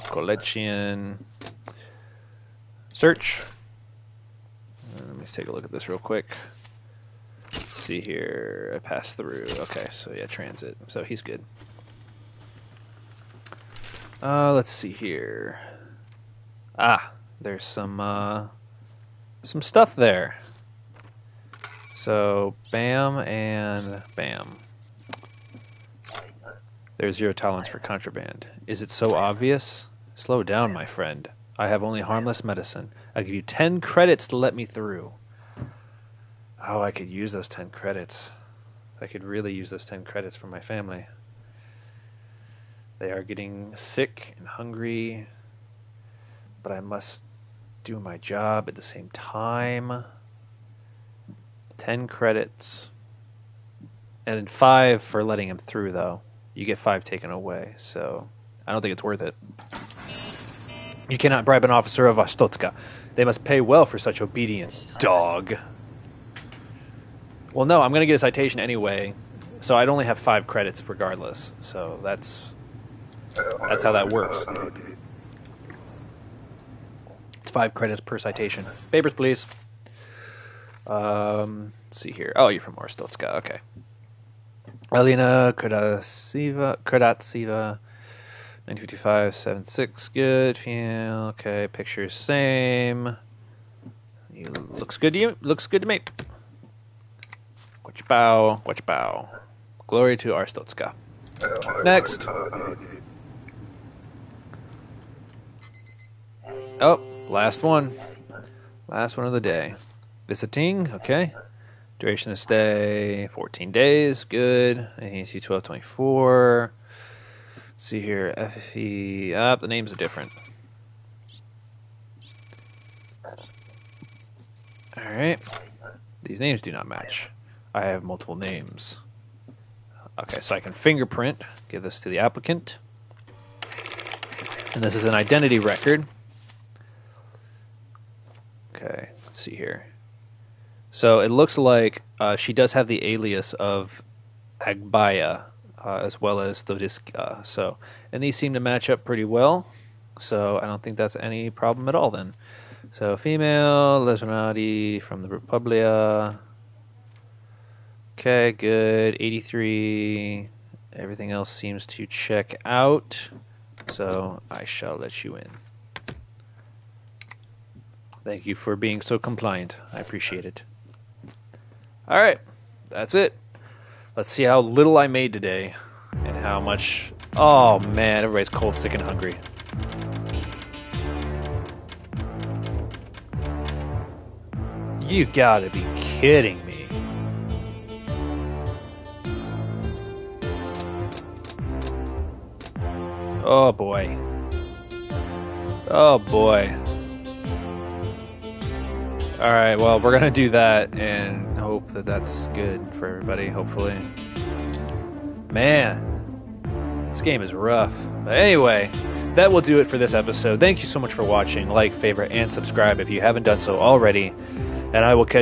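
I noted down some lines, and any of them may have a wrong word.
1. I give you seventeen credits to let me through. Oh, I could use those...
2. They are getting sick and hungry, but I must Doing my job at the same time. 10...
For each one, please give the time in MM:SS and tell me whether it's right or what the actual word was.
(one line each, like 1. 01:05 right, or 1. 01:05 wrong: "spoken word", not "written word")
1. 00:33 wrong: "ten", not "seventeen"
2. 00:42 right.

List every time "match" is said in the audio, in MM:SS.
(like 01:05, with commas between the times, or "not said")
02:06, 02:28.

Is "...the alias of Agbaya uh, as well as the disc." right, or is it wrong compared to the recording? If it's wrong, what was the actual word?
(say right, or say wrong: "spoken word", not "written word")
right.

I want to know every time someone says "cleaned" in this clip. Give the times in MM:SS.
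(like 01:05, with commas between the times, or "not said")
not said.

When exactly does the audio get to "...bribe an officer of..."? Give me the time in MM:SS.
01:01.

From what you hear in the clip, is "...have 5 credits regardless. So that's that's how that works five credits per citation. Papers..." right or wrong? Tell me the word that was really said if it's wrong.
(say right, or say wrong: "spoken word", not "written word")
right.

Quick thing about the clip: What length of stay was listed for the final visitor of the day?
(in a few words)
14 days.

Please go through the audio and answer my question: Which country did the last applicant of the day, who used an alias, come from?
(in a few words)
Republia.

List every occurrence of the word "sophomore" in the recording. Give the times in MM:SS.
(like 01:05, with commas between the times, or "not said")
not said.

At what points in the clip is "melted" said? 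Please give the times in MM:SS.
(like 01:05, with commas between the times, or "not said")
not said.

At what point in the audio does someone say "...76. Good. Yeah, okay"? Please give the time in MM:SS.
01:29.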